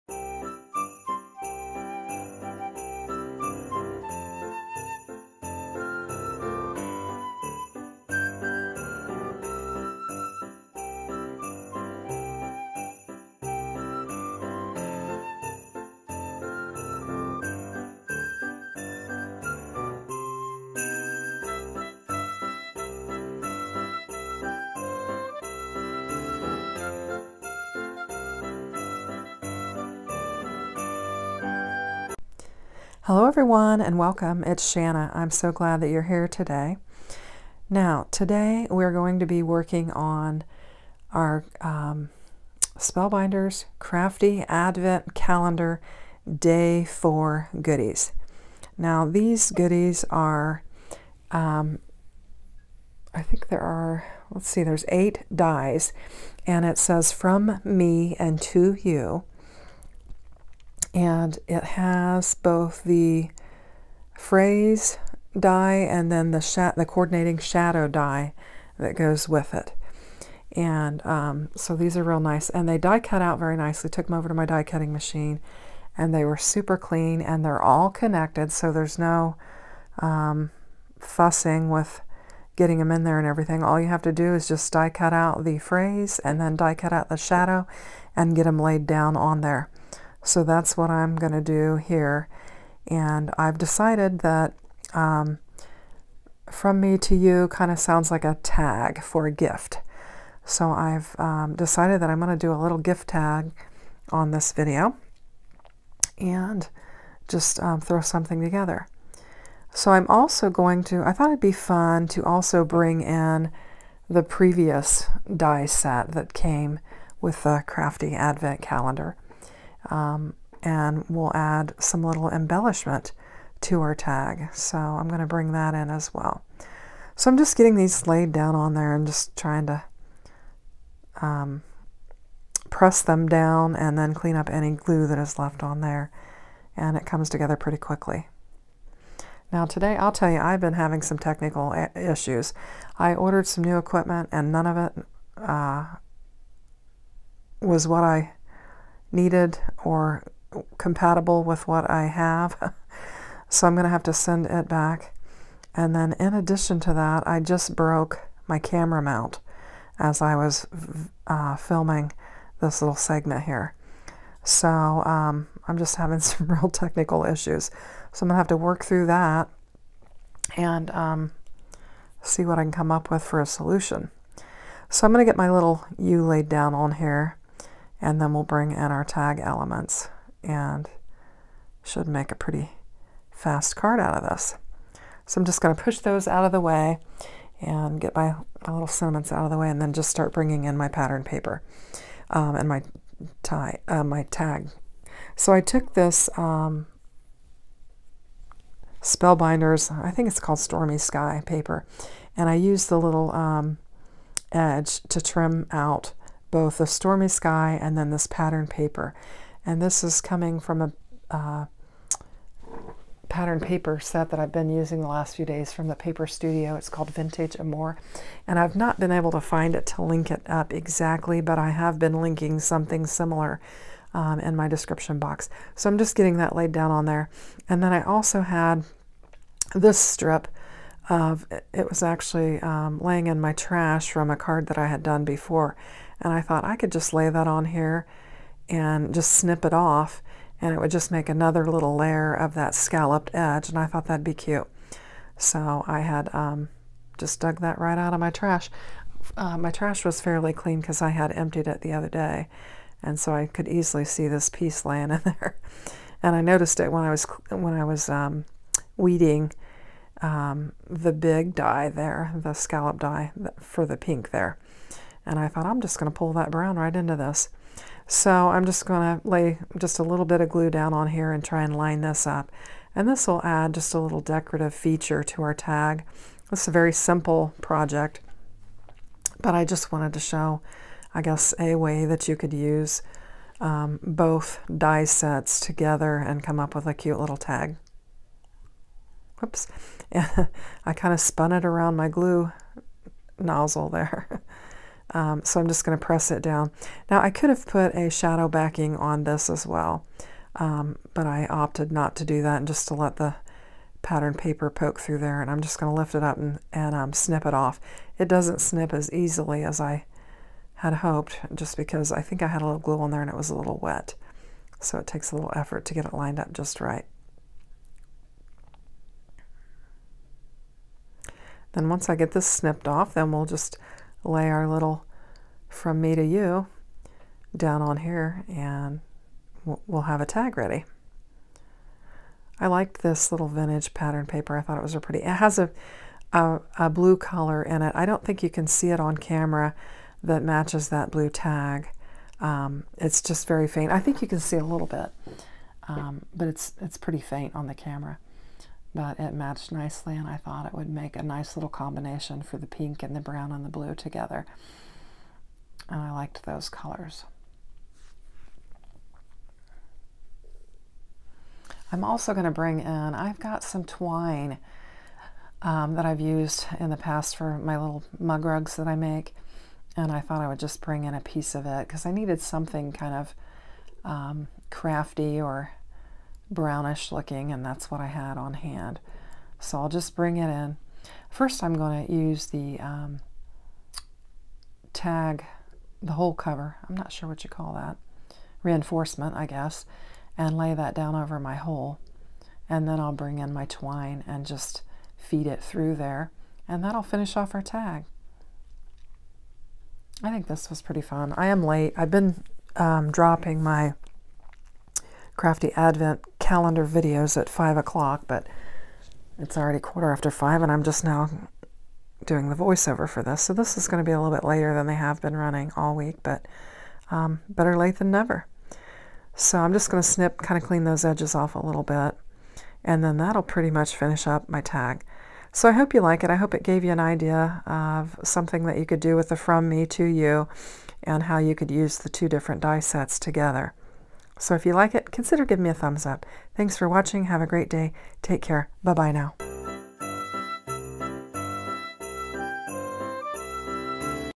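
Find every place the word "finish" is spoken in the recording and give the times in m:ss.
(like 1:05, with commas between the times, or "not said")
6:37, 7:03.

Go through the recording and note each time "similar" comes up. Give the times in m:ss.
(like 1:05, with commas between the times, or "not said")
3:43.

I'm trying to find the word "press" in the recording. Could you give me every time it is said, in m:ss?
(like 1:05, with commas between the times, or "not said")
2:12, 4:56.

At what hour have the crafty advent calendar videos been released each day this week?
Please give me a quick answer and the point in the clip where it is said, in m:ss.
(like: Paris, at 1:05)
5 o'clock, at 6:47.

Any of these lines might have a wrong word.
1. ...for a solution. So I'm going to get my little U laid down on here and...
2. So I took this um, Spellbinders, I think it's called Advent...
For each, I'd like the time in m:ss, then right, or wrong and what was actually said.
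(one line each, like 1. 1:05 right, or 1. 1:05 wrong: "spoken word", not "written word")
1. 2:53 right
2. 3:15 wrong: "Stormy", not "Advent".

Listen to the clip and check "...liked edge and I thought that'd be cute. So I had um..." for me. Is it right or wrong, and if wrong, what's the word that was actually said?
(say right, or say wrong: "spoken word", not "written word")
wrong: "scalloped", not "liked".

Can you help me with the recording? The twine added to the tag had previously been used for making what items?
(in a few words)
mug rugs.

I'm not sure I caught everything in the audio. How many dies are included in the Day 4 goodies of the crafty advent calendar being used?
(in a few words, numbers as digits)
8.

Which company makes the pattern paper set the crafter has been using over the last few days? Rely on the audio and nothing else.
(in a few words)
The Paper Studio.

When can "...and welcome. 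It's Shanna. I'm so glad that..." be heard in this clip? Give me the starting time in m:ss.
0:33.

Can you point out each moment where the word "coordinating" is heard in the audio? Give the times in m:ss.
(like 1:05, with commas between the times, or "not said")
1:06.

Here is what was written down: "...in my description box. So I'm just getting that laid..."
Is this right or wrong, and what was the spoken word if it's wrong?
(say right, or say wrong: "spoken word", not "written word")
right.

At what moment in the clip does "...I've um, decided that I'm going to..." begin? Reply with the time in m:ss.
1:40.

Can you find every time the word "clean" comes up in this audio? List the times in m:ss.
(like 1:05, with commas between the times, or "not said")
1:16, 2:14, 4:10, 7:00.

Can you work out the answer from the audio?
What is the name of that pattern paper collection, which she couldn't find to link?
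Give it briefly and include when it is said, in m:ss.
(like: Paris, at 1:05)
Vintage More, at 3:37.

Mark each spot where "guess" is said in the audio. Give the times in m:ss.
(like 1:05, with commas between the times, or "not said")
4:41, 6:29.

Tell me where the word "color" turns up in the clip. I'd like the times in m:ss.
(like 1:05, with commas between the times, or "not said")
5:37, 5:56.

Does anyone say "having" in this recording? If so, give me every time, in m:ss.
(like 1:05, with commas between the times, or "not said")
2:20, 2:45.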